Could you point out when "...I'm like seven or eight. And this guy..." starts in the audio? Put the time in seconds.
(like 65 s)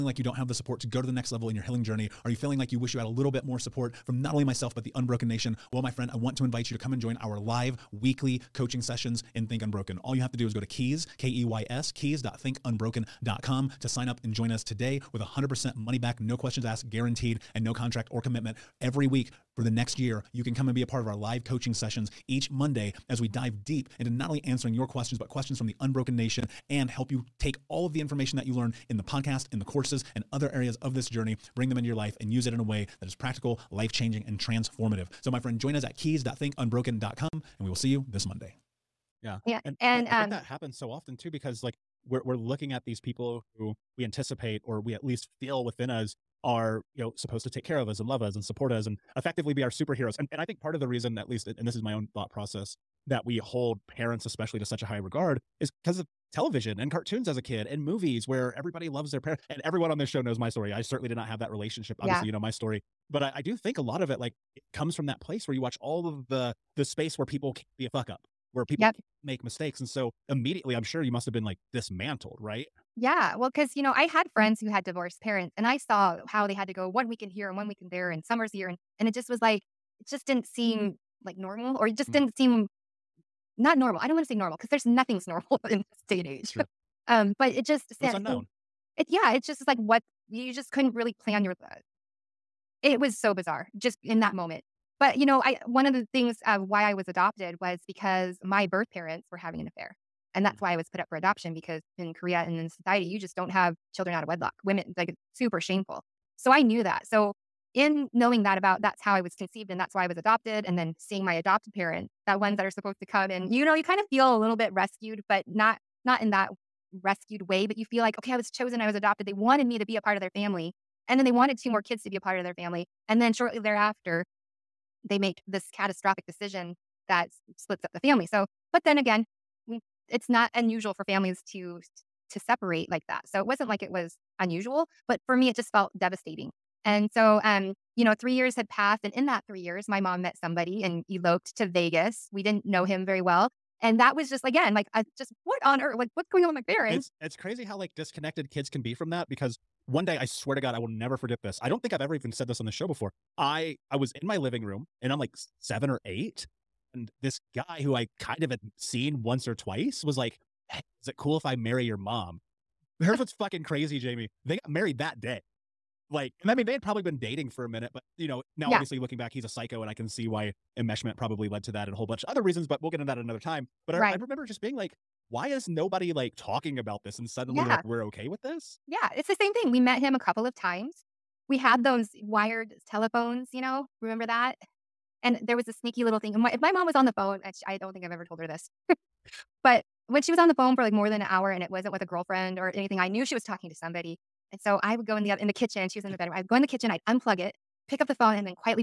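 155 s.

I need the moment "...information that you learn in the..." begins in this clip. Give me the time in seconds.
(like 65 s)
28 s.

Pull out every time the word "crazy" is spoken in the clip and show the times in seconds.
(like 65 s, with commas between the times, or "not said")
147 s, 163 s.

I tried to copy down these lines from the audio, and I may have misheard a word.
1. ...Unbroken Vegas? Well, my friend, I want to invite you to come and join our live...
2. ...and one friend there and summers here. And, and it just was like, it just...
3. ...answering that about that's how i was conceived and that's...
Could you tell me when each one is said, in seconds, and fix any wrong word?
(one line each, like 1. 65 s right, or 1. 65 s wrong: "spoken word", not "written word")
1. 4 s wrong: "Nation", not "Vegas"
2. 77 s wrong: "weekend", not "friend"
3. 108 s wrong: "knowing", not "answering".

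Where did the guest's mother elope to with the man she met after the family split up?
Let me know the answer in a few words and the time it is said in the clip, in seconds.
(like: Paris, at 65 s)
Vegas, at 141 s.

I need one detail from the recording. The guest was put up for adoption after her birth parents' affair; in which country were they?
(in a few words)
Korea.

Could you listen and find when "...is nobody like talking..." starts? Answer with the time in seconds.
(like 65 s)
175 s.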